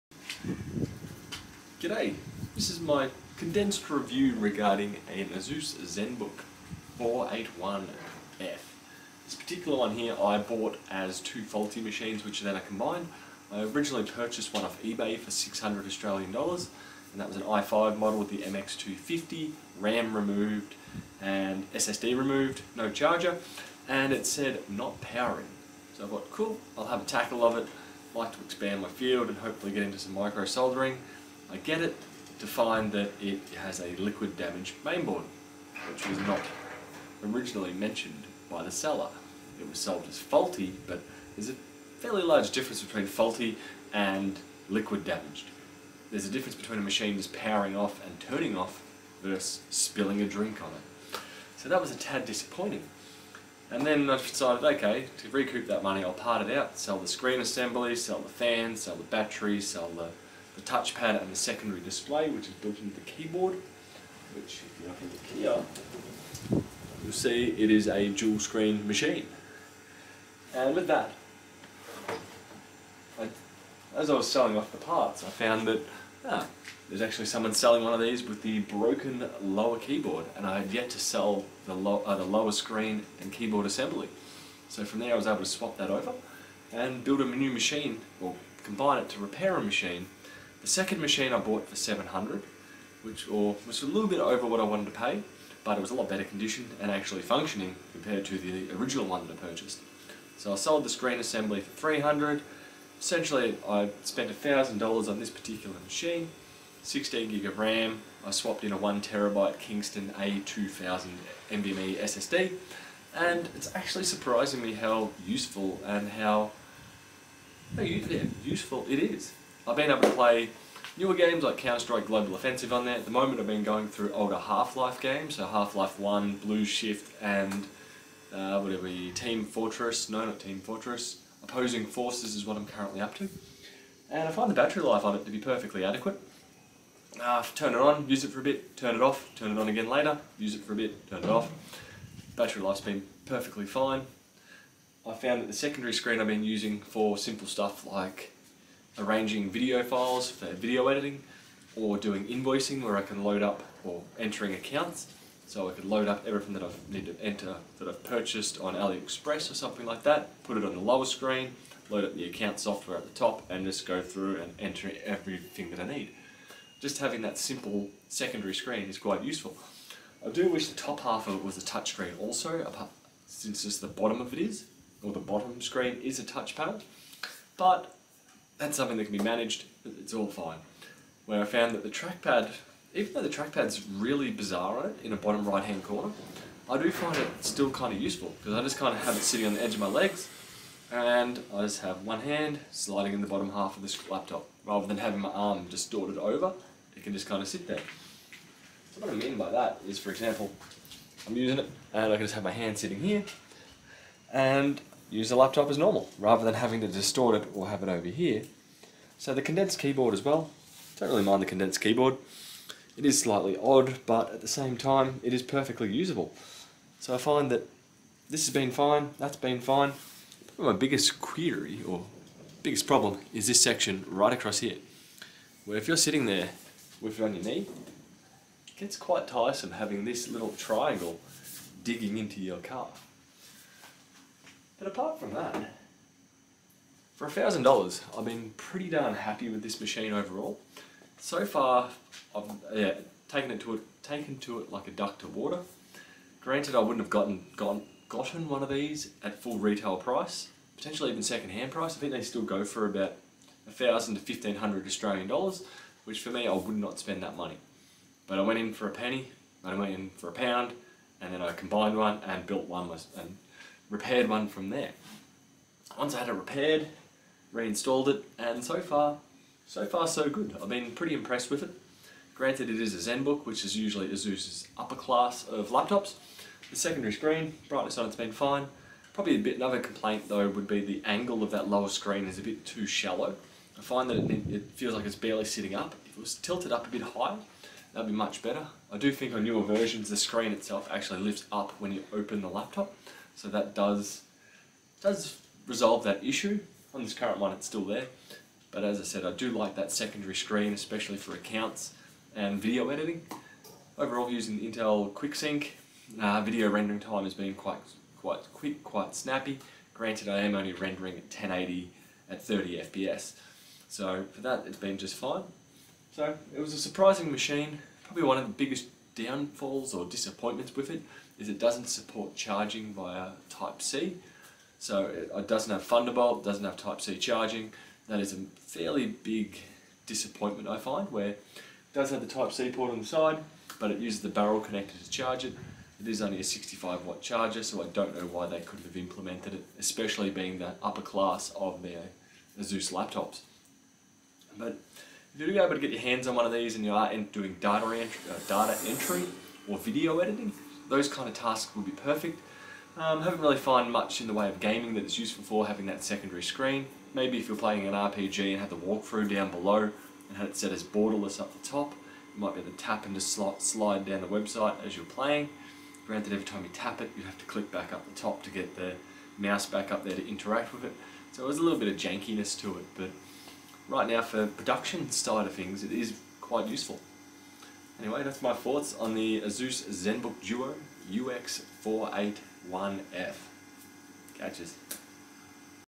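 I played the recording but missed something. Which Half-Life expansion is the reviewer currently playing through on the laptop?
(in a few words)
Opposing Forces.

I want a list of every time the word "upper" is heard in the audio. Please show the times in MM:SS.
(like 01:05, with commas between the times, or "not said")
04:34, 05:40.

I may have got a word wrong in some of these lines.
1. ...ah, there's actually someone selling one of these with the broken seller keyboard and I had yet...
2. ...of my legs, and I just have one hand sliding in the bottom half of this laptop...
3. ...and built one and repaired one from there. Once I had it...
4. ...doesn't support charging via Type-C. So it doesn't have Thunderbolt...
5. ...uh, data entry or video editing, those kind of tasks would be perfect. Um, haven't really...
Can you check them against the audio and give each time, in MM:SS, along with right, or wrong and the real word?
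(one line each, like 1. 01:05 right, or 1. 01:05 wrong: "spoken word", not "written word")
1. 01:16 wrong: "lower", not "seller"
2. 03:09 right
3. 04:22 right
4. 05:21 right
5. 05:48 right.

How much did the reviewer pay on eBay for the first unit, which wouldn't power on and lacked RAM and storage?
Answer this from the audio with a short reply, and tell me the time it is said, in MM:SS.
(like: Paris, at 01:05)
600 Australian dollars, at 00:15.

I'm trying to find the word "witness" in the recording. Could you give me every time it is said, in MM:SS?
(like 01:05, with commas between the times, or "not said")
not said.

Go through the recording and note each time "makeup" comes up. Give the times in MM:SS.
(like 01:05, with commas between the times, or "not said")
not said.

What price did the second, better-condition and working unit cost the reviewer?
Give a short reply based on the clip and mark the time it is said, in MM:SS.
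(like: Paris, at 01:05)
700, at 01:31.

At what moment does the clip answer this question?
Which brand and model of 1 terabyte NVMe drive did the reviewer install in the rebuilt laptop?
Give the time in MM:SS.
01:49.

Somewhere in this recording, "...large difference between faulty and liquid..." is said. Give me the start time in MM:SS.
00:42.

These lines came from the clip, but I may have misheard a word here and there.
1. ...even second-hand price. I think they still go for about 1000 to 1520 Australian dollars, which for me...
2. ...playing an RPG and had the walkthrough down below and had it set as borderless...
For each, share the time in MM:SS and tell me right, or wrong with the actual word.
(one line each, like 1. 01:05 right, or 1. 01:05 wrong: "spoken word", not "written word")
1. 04:11 wrong: "1500", not "1520"
2. 05:57 right.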